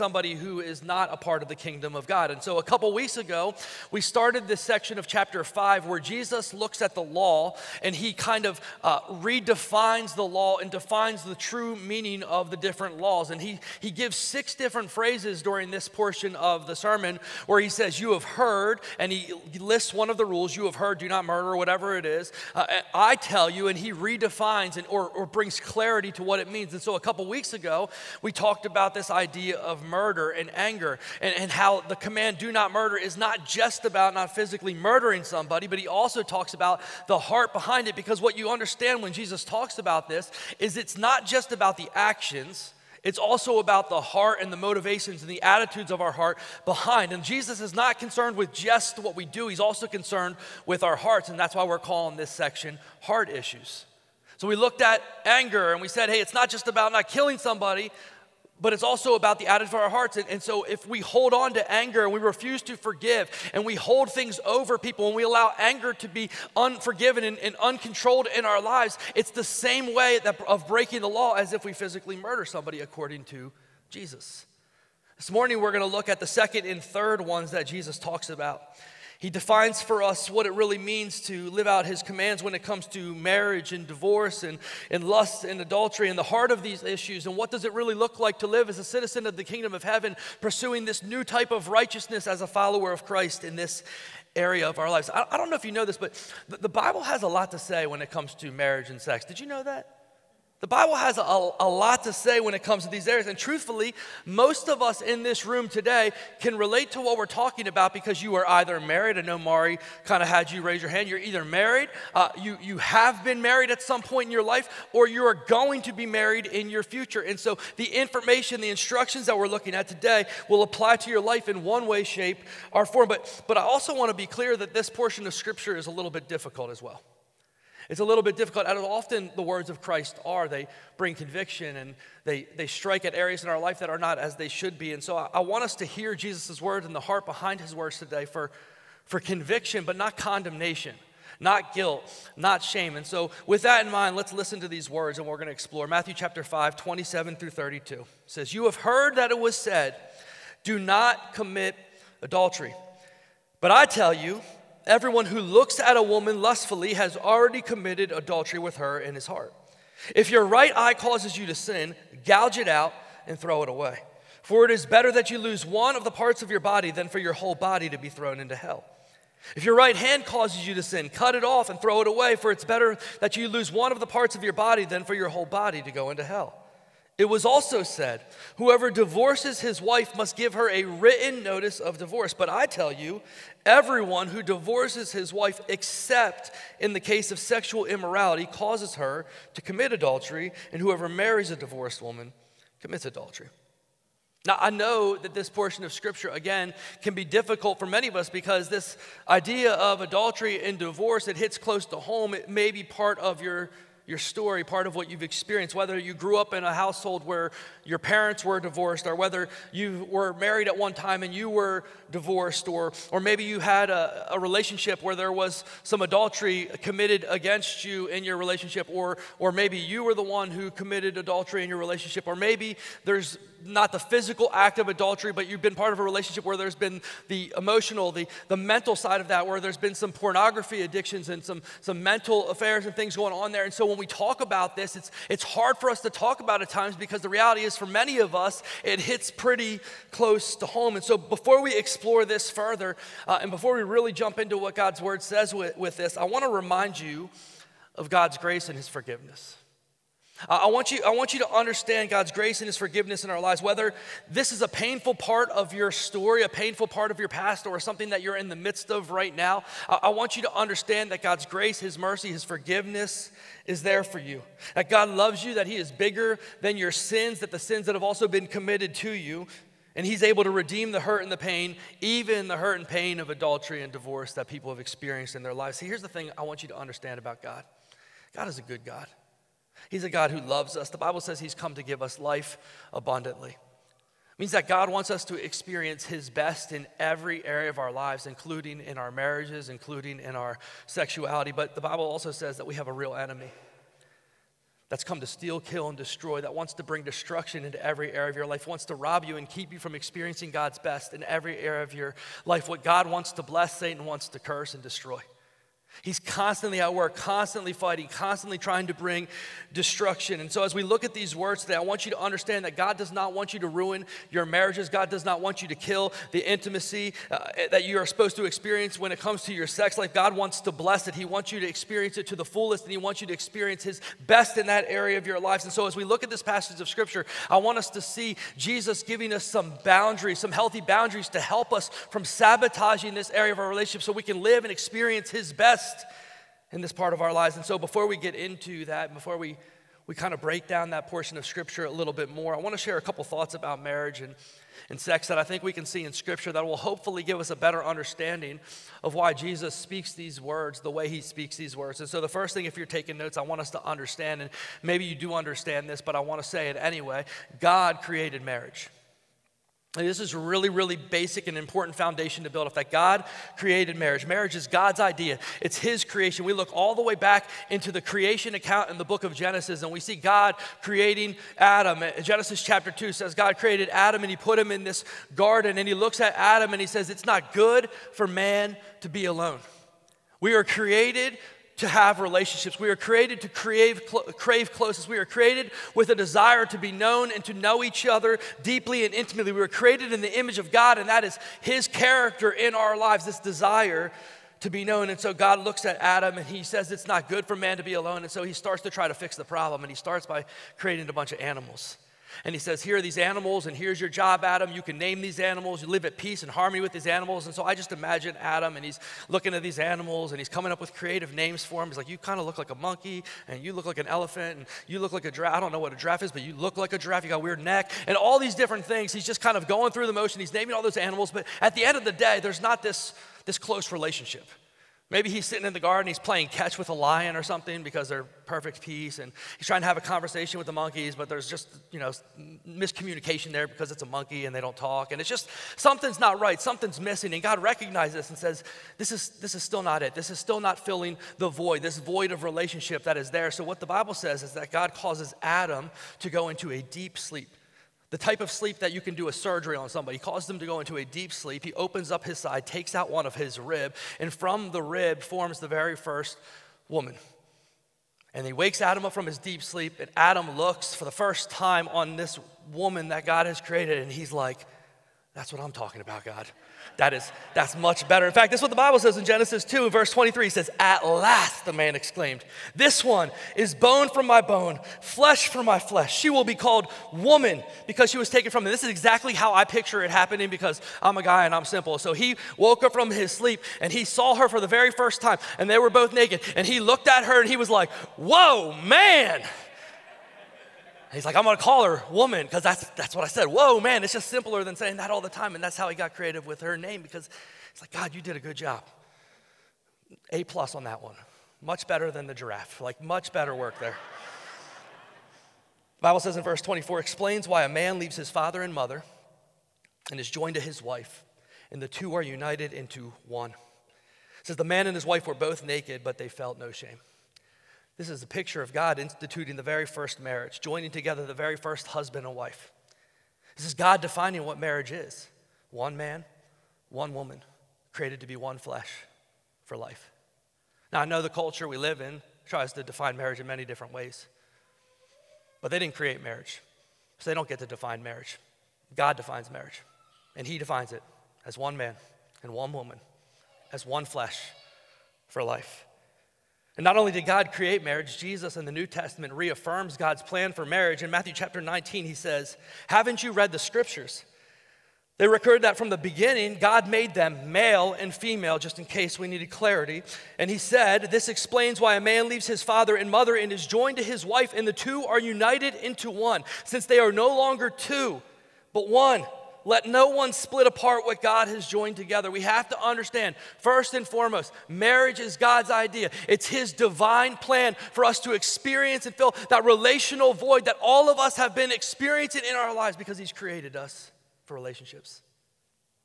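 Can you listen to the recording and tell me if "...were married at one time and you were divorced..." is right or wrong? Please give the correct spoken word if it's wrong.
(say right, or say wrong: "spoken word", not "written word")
right.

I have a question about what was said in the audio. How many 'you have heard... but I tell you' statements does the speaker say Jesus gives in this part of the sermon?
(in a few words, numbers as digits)
6.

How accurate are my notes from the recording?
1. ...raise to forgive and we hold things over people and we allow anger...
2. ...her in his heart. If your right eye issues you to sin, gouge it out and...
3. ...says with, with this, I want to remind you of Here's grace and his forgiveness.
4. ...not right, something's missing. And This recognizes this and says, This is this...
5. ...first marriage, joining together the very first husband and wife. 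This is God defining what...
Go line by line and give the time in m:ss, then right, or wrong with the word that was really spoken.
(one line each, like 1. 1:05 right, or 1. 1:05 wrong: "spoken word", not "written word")
1. 1:02 wrong: "refuse", not "raise"
2. 2:38 wrong: "causes", not "issues"
3. 4:05 wrong: "God", not "Here"
4. 7:16 wrong: "God", not "This"
5. 8:39 right.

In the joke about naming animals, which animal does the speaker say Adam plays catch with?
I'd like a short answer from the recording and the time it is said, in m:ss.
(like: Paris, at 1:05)
a lion, at 7:06.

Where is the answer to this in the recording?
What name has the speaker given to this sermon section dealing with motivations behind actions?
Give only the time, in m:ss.
0:53.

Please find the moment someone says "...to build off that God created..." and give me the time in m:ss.
6:02.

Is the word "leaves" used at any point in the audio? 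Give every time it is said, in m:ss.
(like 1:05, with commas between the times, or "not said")
8:27, 9:22.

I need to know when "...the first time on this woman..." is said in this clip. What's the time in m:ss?
7:41.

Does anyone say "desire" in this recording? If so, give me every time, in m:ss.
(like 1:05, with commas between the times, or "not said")
6:26, 6:33.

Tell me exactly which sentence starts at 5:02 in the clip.
What God wants to bless, Satan wants to curse and destroy.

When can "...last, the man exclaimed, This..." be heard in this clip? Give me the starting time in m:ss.
7:51.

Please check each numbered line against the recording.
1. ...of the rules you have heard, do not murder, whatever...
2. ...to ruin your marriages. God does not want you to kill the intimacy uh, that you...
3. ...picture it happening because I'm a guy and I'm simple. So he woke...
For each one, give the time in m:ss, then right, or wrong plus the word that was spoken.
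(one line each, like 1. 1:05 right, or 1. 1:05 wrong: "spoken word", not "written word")
1. 0:20 right
2. 5:13 right
3. 7:59 right.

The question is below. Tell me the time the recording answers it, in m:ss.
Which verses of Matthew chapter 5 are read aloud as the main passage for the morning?
2:26.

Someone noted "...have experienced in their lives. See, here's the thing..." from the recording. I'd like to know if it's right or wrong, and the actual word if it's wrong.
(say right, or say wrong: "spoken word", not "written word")
right.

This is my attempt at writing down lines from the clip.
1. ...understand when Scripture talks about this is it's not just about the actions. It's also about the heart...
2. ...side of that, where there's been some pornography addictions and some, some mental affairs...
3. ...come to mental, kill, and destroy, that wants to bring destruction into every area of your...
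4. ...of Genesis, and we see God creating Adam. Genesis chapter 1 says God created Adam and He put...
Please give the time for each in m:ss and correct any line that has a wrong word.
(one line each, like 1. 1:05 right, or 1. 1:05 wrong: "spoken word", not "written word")
1. 0:38 wrong: "Jesus", not "Scripture"
2. 3:48 right
3. 4:55 wrong: "steal", not "mental"
4. 6:09 wrong: "2", not "1".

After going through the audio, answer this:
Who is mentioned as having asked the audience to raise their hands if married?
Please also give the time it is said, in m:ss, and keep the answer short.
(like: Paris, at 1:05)
Mari, at 1:49.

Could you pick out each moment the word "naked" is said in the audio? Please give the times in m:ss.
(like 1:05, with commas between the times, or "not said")
8:06, 8:35.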